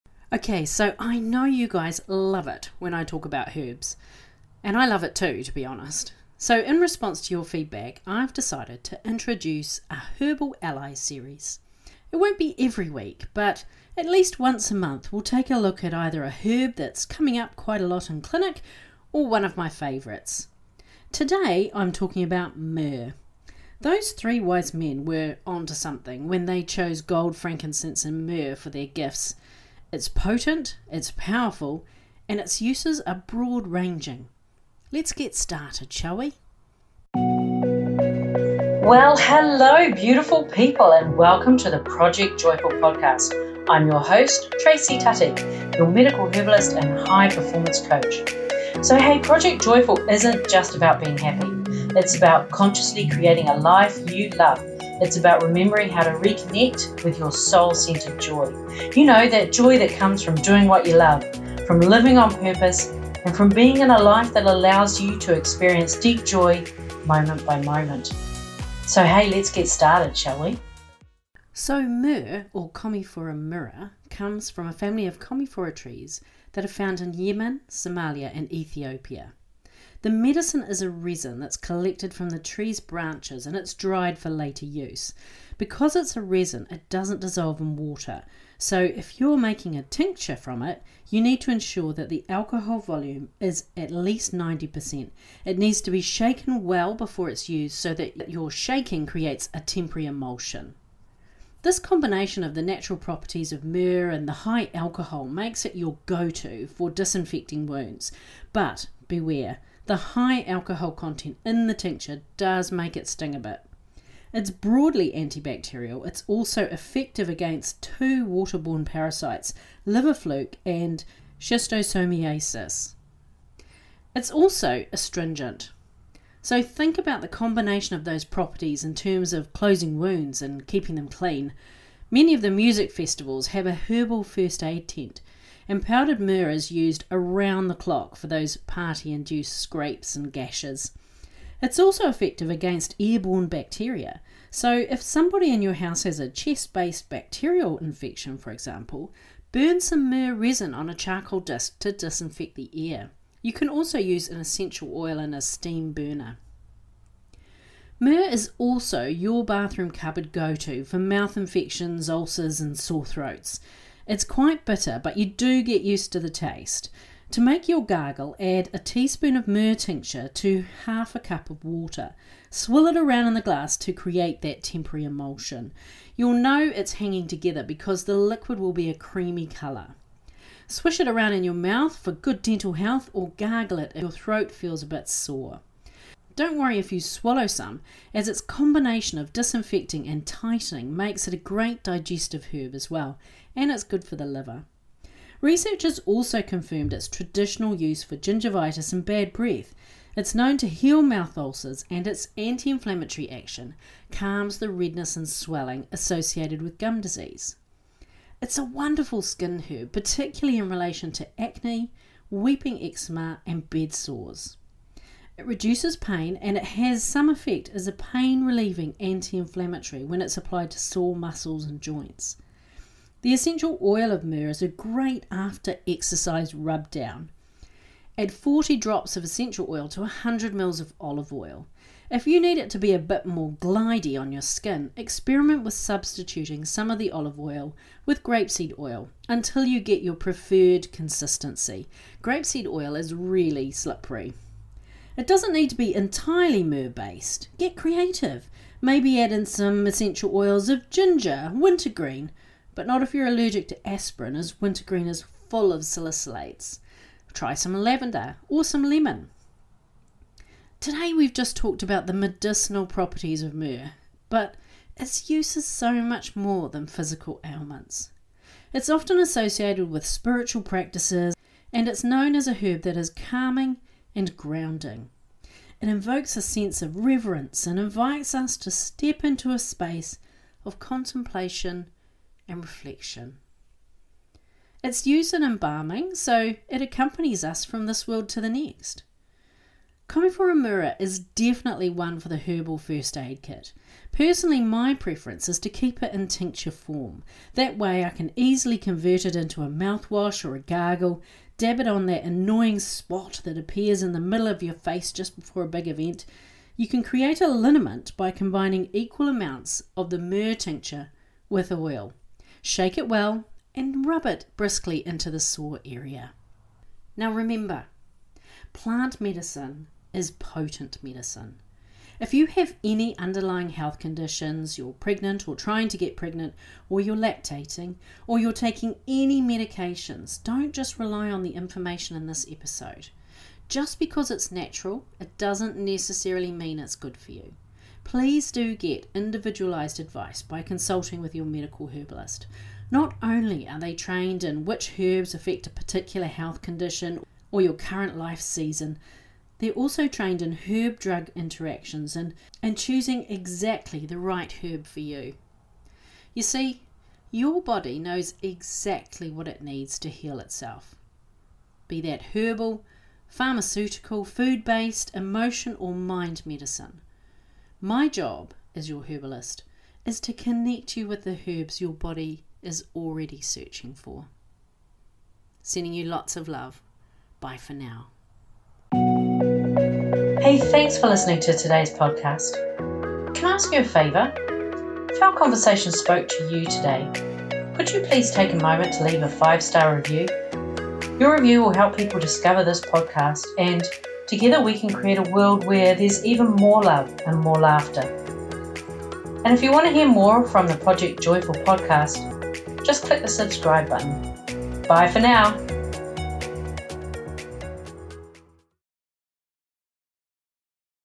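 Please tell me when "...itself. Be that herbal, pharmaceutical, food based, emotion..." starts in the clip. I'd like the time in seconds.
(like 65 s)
360 s.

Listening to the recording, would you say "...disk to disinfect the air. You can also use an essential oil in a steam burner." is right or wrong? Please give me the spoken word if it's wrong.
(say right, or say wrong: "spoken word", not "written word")
right.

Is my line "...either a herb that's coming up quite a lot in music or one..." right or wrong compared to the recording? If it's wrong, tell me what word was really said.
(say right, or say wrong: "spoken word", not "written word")
wrong: "clinic", not "music".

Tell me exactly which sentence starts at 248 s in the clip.
Maybe add in some essential oils of ginger, wintergreen, but not if you're allergic to aspirin, as wintergreen is full of salicylates.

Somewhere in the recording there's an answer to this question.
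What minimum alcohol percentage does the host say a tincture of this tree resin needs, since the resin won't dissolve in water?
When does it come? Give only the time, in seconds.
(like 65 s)
94 s.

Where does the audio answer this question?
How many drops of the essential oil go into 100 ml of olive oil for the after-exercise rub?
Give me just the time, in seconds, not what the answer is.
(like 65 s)
228 s.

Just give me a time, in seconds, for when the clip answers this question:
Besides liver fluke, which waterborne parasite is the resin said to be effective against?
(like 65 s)
121 s.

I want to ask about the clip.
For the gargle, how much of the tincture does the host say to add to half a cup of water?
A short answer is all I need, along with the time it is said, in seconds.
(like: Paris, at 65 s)
a teaspoon, at 168 s.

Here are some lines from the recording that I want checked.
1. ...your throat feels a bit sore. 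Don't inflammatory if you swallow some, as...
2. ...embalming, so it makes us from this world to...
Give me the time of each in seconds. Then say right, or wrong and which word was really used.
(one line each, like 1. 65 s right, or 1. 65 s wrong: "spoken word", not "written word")
1. 184 s wrong: "worry", not "inflammatory"
2. 285 s wrong: "accompanies", not "makes".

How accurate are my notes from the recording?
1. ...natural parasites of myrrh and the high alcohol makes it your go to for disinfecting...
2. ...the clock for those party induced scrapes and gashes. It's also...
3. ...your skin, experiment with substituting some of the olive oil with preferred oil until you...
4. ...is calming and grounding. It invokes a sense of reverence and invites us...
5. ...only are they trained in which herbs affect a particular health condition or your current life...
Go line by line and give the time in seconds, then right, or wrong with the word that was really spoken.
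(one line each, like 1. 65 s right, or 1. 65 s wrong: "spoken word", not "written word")
1. 102 s wrong: "properties", not "parasites"
2. 137 s right
3. 234 s wrong: "grapeseed", not "preferred"
4. 272 s right
5. 343 s right.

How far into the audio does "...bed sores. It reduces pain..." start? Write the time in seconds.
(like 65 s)
213 s.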